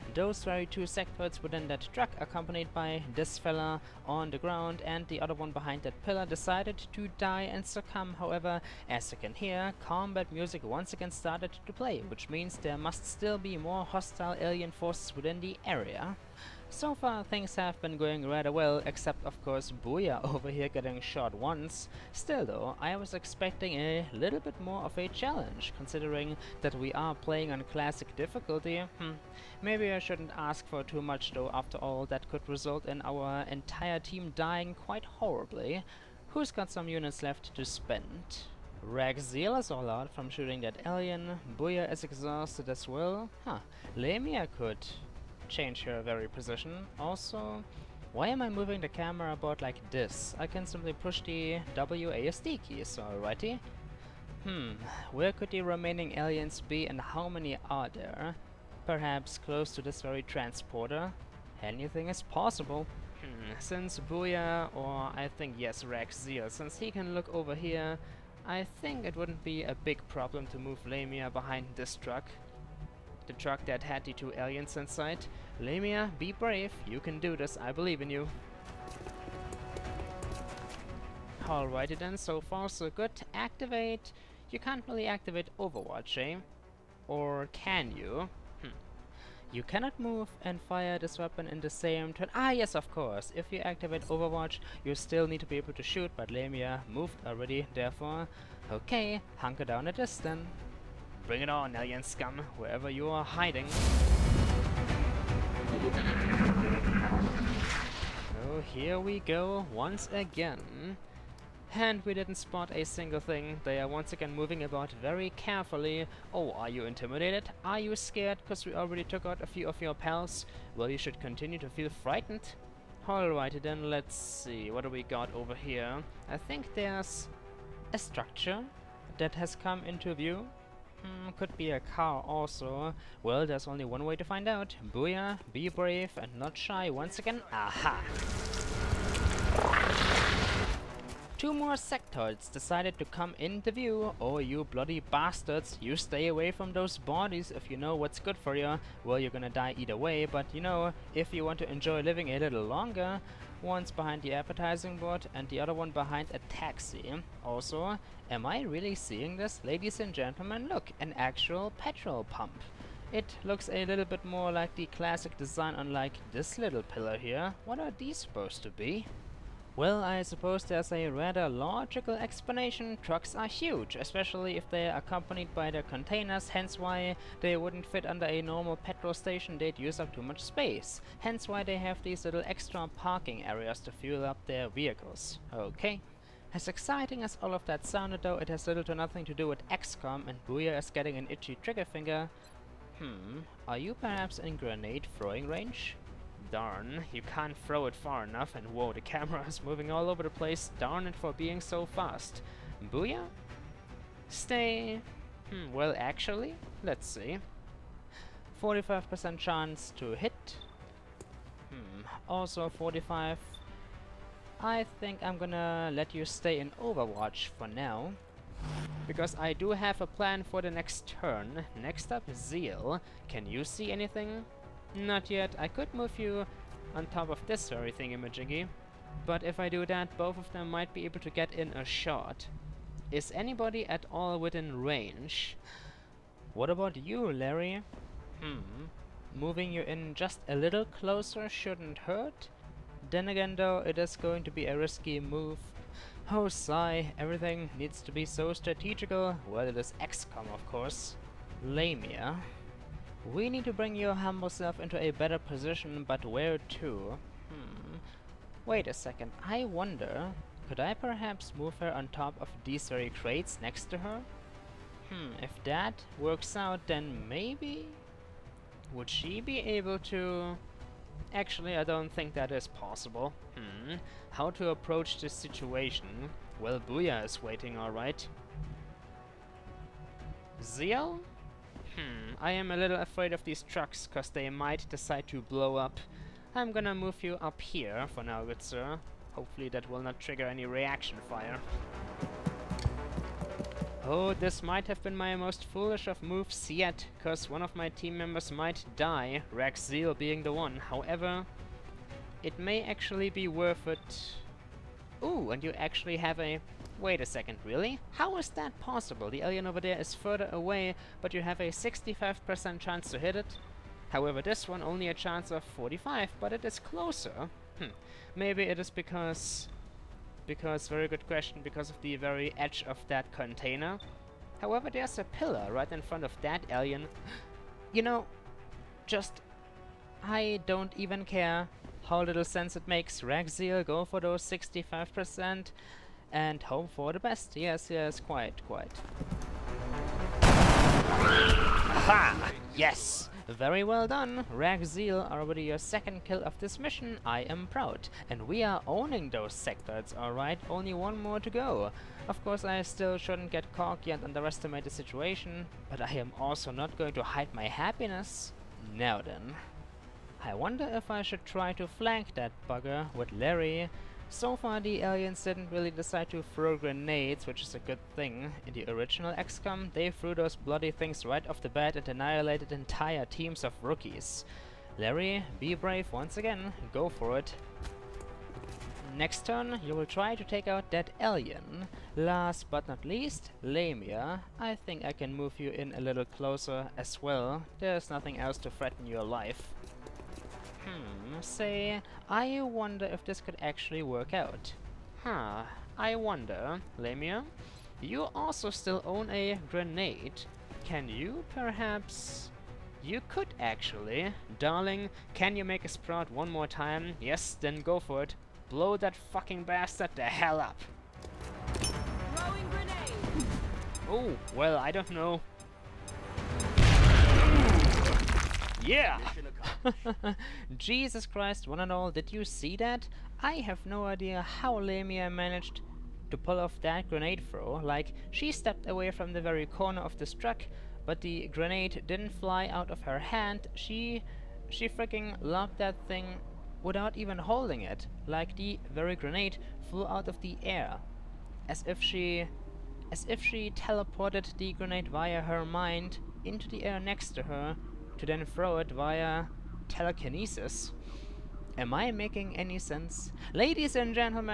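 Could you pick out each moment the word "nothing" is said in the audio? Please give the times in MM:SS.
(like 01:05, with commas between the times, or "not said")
03:08, 06:28.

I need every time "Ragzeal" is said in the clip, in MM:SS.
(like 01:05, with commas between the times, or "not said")
00:38, 05:33.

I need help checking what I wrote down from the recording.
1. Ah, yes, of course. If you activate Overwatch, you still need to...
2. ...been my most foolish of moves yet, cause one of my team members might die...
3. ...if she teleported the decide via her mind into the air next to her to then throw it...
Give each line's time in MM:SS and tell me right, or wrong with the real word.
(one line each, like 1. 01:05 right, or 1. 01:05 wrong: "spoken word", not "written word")
1. 01:32 right
2. 04:55 right
3. 07:23 wrong: "grenade", not "decide".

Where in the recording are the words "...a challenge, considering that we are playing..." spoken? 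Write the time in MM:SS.
00:24.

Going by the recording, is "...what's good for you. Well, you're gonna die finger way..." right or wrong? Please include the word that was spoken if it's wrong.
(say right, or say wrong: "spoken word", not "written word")
wrong: "either", not "finger".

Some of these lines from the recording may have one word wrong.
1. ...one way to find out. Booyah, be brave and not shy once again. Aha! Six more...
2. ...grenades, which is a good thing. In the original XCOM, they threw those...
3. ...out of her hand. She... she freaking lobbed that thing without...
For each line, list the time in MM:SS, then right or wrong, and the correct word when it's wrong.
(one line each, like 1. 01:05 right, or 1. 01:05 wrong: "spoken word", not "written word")
1. 02:13 wrong: "Two", not "Six"
2. 06:06 right
3. 07:12 right.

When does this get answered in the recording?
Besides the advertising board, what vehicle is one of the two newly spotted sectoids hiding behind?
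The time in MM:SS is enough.
02:36.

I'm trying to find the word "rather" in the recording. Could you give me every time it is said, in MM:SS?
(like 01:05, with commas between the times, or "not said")
00:18, 02:51.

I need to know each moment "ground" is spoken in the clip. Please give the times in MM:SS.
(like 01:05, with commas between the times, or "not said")
00:04.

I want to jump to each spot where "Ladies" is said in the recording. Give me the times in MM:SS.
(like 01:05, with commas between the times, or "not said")
02:39, 07:33.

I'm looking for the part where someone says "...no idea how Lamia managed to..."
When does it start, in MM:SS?
07:03.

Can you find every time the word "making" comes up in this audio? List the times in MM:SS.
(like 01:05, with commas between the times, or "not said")
07:32.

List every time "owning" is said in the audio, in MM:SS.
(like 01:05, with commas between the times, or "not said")
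05:48.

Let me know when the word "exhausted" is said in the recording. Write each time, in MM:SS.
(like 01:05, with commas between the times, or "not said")
00:42.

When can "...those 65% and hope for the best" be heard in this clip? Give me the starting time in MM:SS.
05:34.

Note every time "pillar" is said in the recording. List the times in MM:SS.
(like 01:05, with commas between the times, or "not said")
00:06, 02:46, 05:25.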